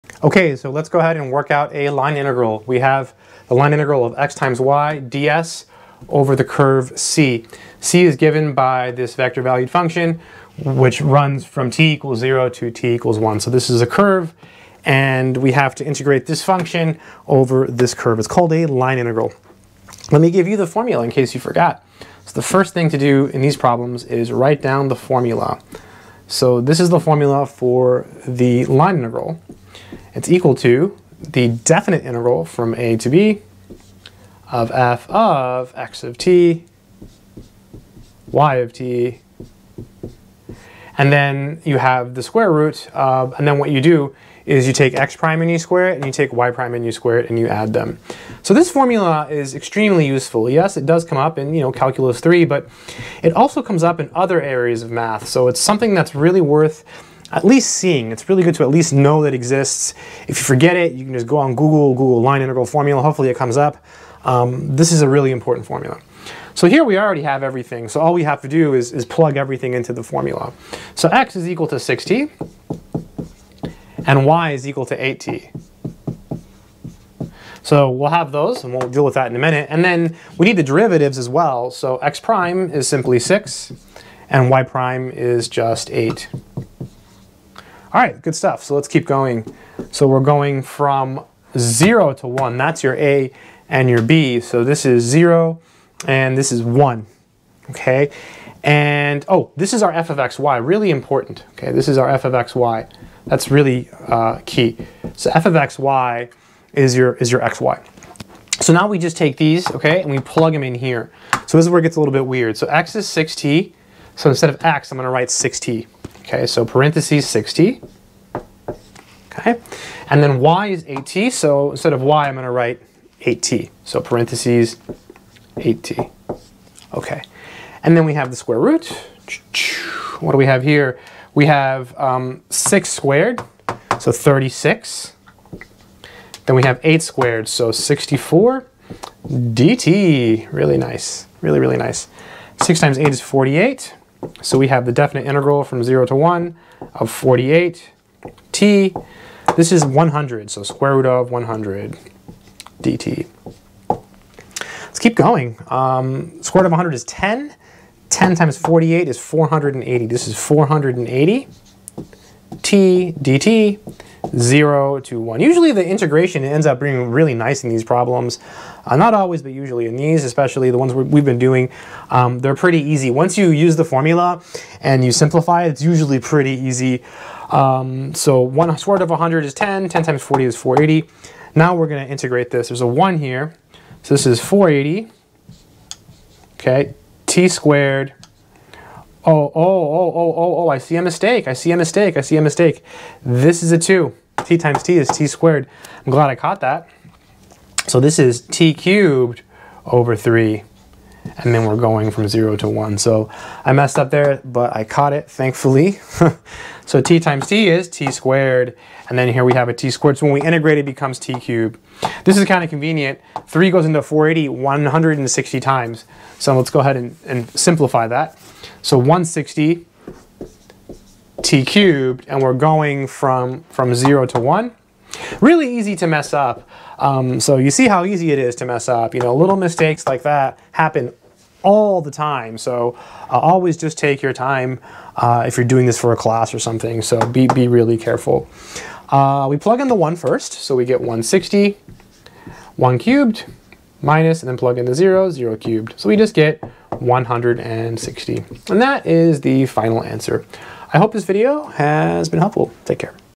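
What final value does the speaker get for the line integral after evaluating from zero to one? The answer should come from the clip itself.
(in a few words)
160.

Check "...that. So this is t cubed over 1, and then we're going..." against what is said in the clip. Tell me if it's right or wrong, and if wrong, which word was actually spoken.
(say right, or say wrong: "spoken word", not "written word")
wrong: "3", not "1".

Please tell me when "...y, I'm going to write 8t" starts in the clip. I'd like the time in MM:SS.
02:02.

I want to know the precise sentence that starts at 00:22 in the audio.
So the first thing to do in these problems is write down the formula.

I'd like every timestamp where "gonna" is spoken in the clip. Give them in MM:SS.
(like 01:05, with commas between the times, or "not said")
01:54, 03:01.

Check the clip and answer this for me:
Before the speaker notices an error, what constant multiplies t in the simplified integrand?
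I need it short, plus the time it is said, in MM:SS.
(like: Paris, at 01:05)
480, at 02:38.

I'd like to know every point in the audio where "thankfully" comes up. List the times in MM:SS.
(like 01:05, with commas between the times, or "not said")
03:25.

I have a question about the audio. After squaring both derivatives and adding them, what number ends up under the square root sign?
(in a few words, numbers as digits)
100.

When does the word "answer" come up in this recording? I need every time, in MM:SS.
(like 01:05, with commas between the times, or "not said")
04:10.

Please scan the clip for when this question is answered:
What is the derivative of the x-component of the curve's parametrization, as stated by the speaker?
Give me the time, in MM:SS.
01:21.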